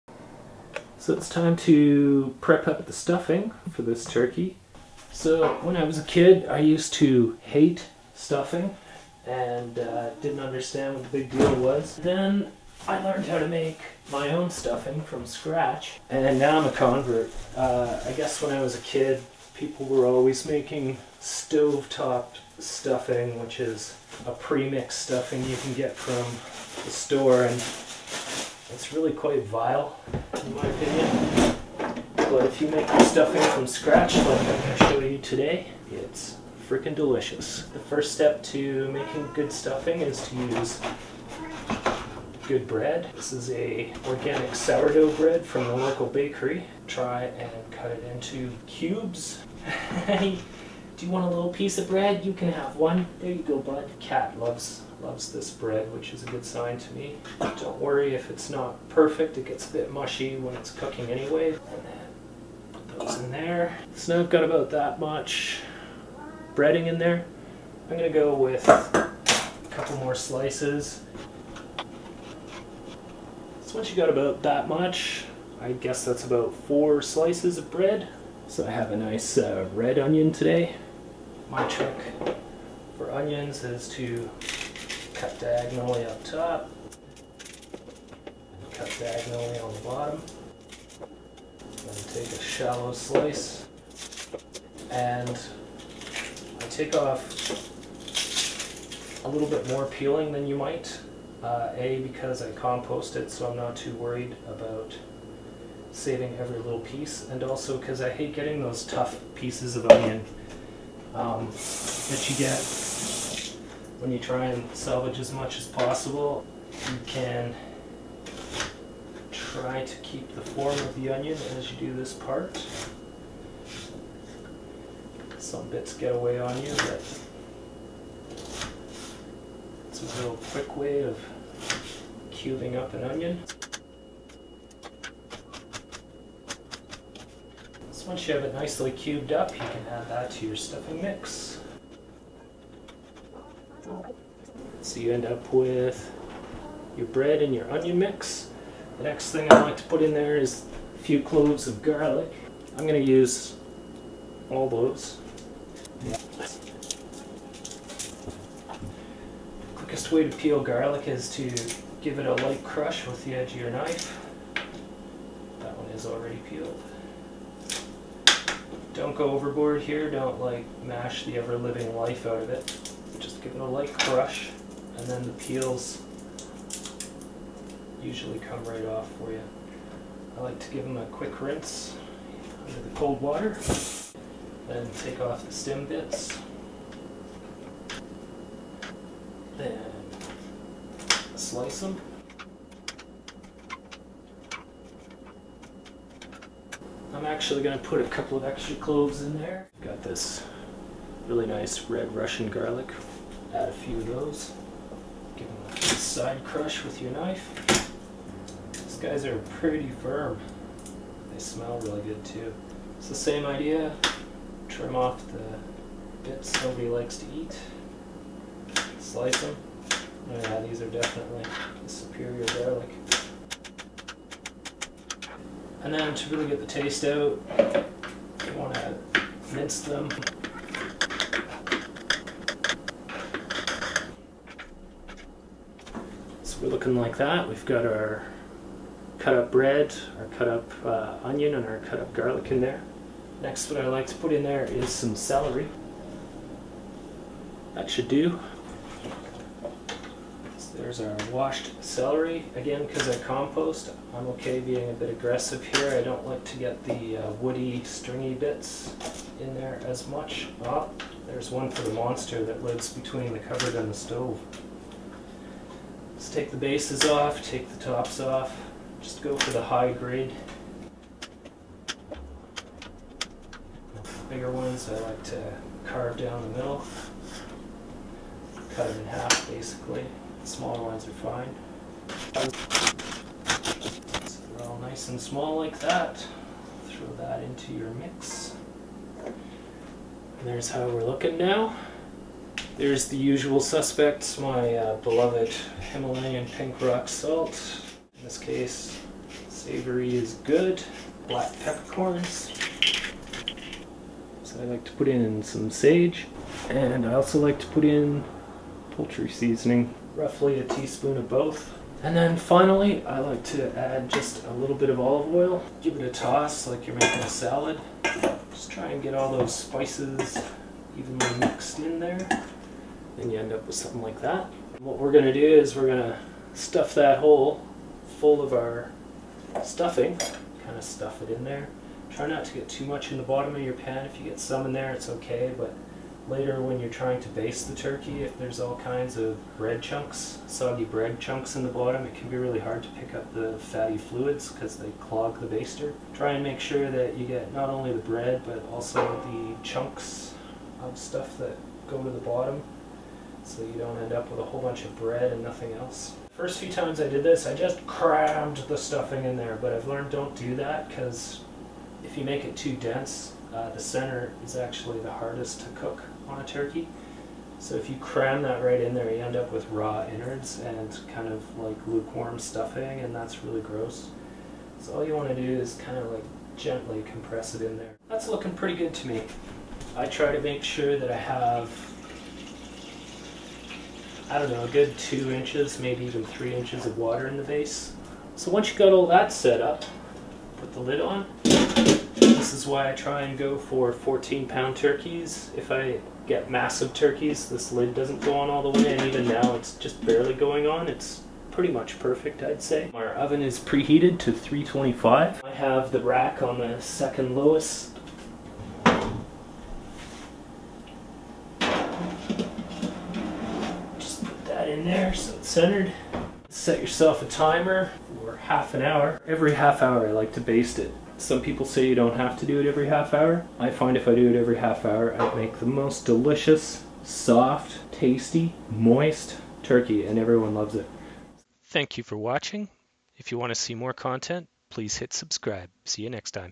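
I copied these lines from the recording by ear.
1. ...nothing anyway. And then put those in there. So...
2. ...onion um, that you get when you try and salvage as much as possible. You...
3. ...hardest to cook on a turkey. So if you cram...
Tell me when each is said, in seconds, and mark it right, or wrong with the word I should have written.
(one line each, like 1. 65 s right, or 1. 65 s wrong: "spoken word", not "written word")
1. 60 s wrong: "cooking", not "nothing"
2. 109 s right
3. 365 s right.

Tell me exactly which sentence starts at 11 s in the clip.
Then I learned how to make my own stuffing from scratch, and now I'm a convert.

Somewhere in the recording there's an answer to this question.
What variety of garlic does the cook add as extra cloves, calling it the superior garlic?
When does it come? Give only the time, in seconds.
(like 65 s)
201 s.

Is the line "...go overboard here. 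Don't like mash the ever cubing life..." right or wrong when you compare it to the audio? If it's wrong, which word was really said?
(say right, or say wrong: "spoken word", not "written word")
wrong: "living", not "cubing".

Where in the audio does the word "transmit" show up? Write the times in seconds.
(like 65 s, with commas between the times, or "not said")
not said.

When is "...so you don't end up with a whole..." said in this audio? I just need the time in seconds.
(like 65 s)
353 s.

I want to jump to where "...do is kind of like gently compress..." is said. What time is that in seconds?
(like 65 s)
375 s.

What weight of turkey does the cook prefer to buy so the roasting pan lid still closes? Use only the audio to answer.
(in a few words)
14 pounds.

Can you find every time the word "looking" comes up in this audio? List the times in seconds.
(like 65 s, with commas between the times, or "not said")
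236 s, 291 s, 378 s.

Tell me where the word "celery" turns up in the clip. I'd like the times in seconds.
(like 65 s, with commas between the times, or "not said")
245 s, 251 s.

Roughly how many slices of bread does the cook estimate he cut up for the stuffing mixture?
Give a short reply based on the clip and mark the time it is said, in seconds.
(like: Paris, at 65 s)
4, at 76 s.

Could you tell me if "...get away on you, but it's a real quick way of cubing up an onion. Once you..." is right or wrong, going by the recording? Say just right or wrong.
right.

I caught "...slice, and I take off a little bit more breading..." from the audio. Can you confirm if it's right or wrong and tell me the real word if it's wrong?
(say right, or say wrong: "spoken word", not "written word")
wrong: "peeling", not "breading".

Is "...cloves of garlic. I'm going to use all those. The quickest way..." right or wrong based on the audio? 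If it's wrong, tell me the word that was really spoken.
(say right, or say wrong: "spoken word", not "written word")
right.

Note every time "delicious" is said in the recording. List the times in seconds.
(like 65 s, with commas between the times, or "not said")
36 s, 426 s.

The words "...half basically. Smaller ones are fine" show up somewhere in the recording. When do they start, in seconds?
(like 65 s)
279 s.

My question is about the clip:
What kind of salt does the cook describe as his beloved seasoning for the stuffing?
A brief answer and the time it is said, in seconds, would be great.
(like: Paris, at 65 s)
Himalayan pink rock salt, at 295 s.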